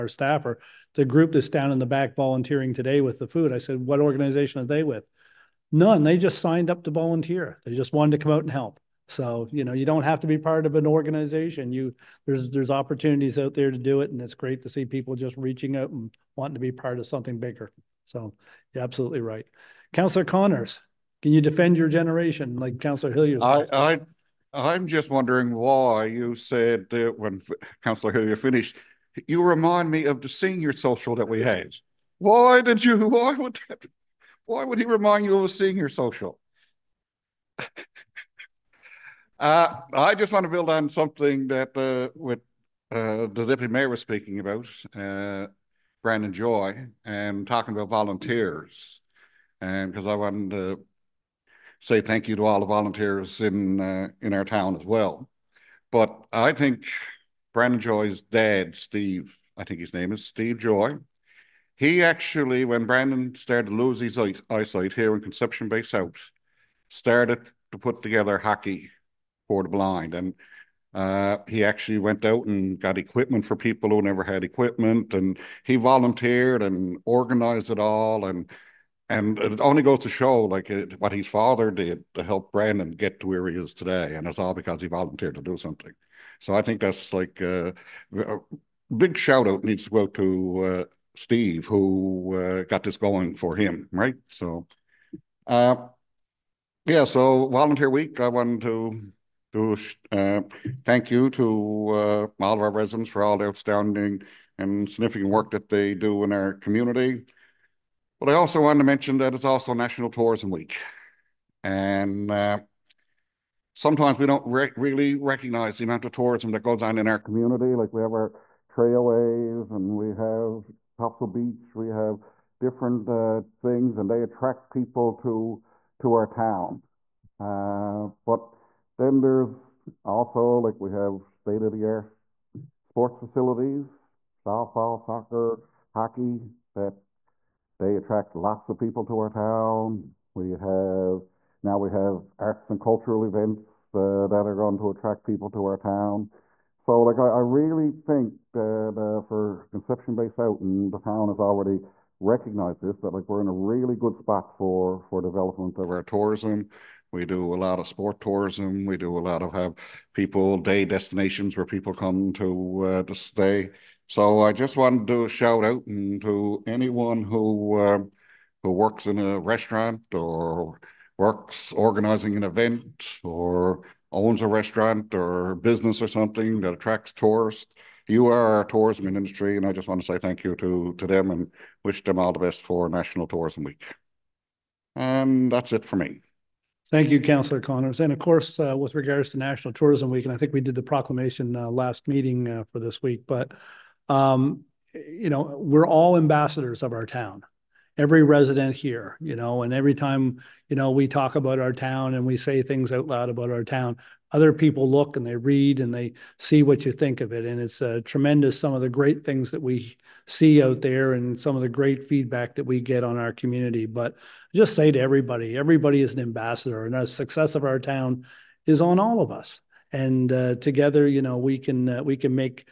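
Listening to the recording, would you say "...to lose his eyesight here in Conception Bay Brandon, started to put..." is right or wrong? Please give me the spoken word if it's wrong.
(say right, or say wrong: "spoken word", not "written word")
wrong: "South", not "Brandon".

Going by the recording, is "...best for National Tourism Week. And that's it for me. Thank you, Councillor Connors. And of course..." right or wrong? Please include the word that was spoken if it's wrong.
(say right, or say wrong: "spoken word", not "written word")
right.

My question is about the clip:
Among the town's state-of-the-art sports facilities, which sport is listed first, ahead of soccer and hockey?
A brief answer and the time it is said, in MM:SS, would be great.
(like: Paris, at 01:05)
Softball, at 02:14.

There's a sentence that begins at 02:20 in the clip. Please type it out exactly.
We have now we have arts and cultural events uh, that are going to attract people to our town.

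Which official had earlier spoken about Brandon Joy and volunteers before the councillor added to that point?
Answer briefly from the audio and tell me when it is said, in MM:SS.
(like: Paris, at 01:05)
Deputy mayor, at 00:43.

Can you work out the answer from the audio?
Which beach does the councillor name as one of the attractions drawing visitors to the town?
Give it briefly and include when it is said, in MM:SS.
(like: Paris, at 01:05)
Topsail Beach, at 02:00.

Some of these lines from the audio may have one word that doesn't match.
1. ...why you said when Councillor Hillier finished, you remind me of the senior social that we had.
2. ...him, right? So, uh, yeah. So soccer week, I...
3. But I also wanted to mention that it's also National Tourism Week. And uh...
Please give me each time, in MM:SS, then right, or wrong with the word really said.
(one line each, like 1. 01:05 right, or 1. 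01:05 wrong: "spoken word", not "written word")
1. 00:25 right
2. 01:33 wrong: "volunteer", not "soccer"
3. 01:48 right.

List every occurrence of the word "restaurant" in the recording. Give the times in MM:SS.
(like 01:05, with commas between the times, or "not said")
02:49, 02:54.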